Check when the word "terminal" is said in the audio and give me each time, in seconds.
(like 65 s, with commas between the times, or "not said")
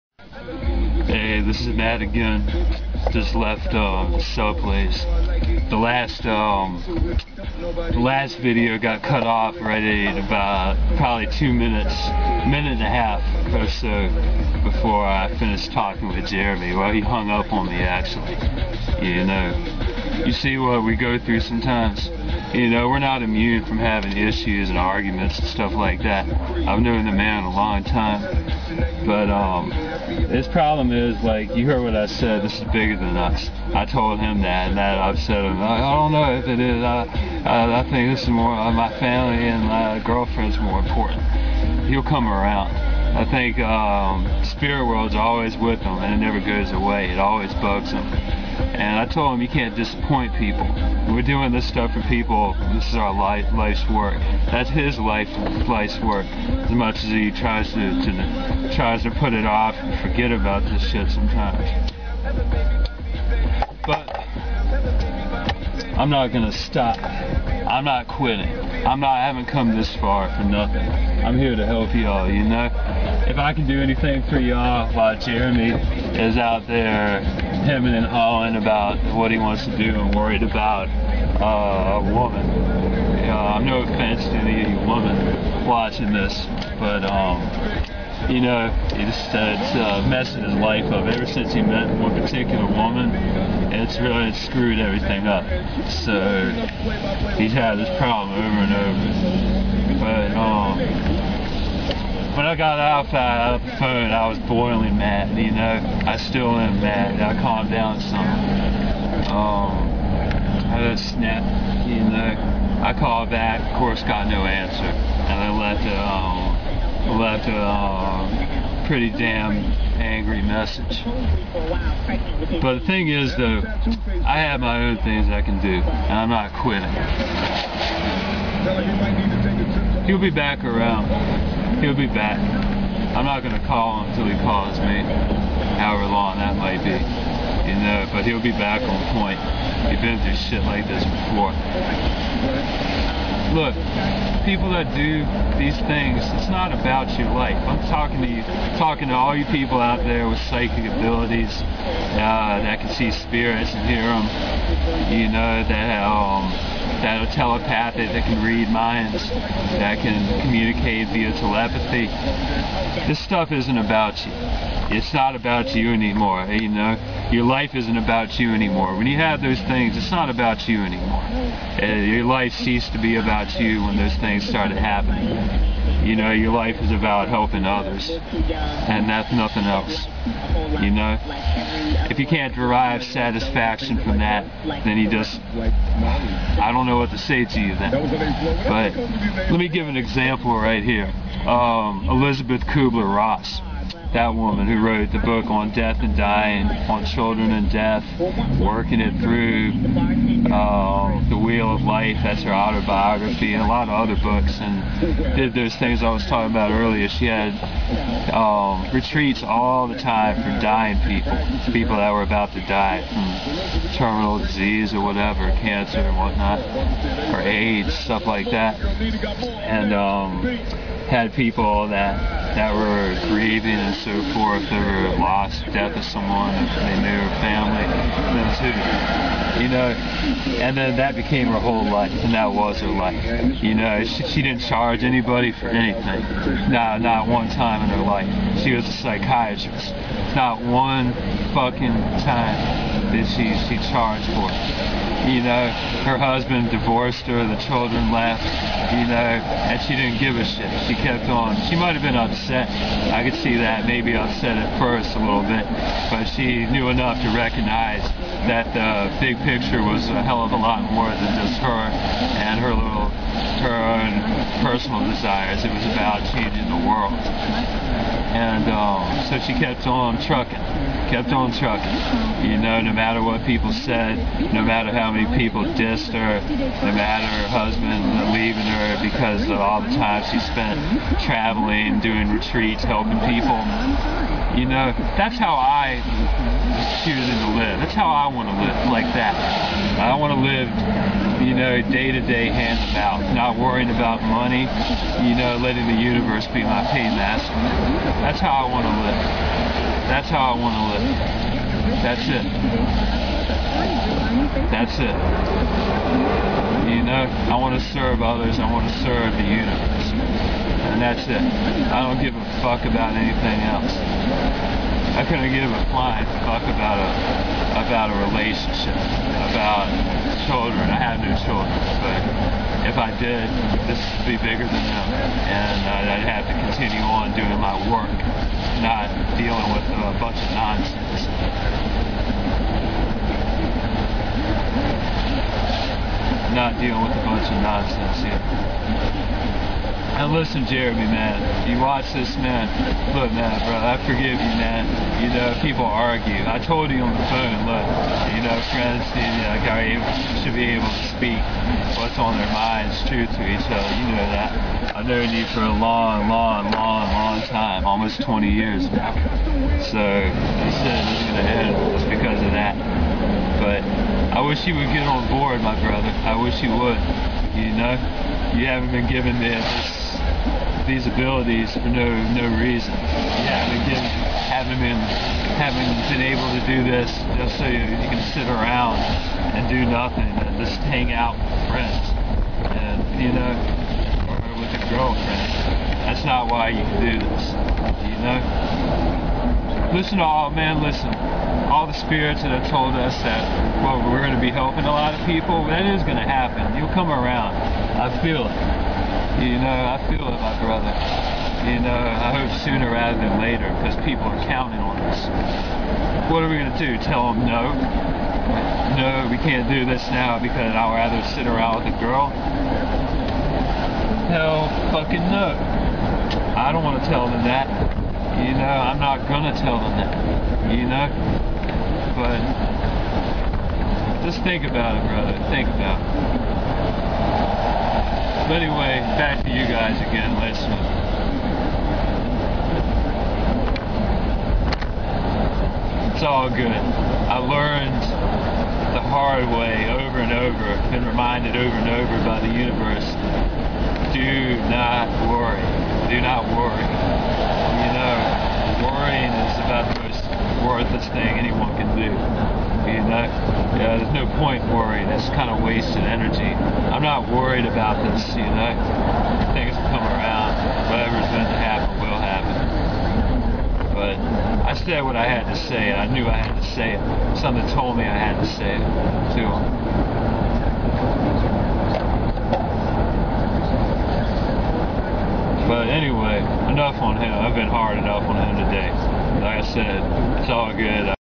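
213 s.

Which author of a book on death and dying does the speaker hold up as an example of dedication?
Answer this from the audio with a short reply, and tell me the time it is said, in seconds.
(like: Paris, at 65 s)
Elisabeth Kubler-Ross, at 192 s.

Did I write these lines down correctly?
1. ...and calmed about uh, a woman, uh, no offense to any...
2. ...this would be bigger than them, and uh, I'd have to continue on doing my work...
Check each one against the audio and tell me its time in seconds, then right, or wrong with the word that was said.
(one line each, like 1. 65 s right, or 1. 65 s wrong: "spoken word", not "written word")
1. 79 s wrong: "worried", not "calmed"
2. 323 s right.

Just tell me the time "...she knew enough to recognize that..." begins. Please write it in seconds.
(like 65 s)
256 s.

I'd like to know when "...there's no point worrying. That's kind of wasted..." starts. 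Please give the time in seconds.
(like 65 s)
453 s.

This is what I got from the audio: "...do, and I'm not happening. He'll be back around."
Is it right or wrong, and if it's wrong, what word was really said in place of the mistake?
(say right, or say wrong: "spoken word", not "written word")
wrong: "quitting", not "happening".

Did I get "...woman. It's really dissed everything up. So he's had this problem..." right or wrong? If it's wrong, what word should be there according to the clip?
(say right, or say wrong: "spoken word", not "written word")
wrong: "screwed", not "dissed".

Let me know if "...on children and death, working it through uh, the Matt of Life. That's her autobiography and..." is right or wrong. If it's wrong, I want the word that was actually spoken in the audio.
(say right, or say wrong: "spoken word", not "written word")
wrong: "Wheel", not "Matt".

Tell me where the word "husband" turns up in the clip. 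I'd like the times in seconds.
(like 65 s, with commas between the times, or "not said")
246 s, 277 s.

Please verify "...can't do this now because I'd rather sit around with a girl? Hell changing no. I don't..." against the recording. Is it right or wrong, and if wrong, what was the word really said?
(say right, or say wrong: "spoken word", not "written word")
wrong: "fucking", not "changing".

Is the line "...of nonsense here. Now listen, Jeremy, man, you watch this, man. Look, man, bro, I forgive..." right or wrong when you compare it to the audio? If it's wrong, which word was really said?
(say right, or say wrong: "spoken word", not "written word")
right.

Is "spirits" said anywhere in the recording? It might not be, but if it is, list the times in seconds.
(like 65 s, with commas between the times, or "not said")
44 s, 153 s, 391 s.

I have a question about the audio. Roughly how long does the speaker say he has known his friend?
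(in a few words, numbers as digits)
Almost 20 years.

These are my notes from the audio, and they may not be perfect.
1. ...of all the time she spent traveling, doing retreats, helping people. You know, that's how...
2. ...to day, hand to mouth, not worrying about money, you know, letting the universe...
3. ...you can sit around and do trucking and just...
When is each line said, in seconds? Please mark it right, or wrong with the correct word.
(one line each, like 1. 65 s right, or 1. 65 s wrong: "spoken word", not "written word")
1. 279 s right
2. 292 s right
3. 377 s wrong: "nothing", not "trucking".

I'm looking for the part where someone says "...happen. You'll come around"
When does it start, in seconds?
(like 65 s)
396 s.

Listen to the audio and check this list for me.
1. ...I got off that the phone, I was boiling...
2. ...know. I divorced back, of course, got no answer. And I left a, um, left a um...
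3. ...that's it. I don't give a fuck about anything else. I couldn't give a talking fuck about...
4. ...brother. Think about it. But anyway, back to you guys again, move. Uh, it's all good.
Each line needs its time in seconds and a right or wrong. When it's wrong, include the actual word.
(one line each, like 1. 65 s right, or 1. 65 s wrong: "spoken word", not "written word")
1. 102 s right
2. 111 s wrong: "called", not "divorced"
3. 311 s wrong: "flying", not "talking"
4. 425 s right.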